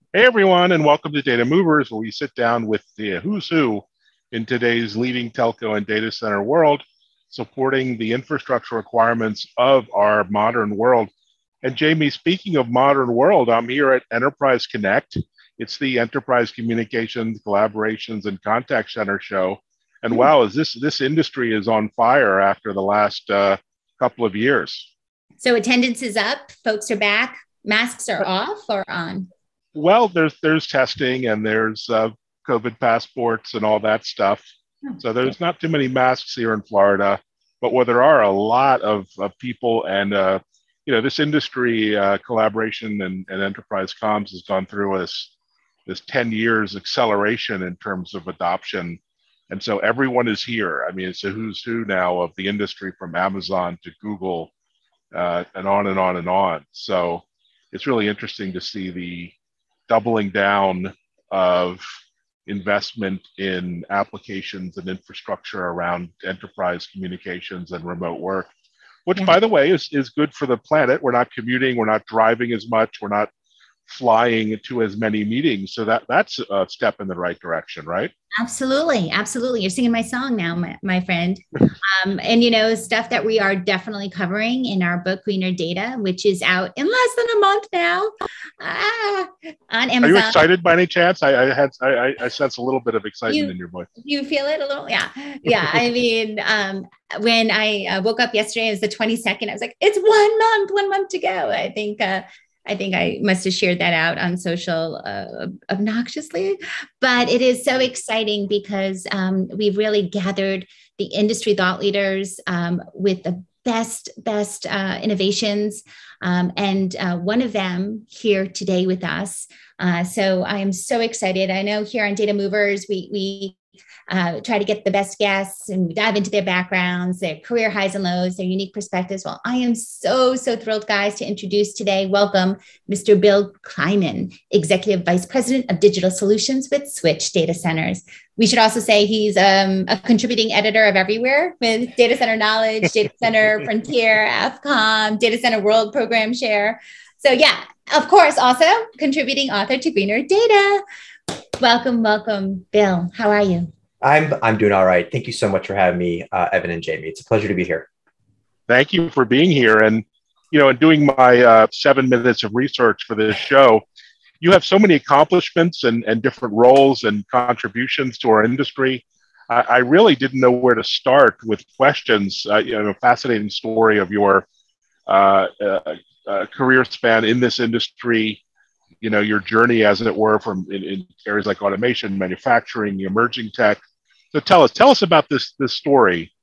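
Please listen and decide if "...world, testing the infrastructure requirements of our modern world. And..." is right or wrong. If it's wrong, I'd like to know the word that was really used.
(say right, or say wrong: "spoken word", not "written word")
wrong: "supporting", not "testing".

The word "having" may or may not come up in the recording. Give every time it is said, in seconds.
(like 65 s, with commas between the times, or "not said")
155 s.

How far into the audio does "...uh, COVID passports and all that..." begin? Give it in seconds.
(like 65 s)
31 s.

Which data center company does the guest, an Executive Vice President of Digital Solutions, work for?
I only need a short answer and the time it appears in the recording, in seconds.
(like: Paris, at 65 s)
Switch, at 136 s.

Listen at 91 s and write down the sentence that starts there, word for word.
I, I had I, I sense a little bit of excitement you, in your voice.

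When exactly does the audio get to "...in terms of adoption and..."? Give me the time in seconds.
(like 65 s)
47 s.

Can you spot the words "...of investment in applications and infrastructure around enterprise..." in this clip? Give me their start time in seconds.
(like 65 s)
61 s.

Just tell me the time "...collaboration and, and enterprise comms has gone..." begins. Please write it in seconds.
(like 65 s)
42 s.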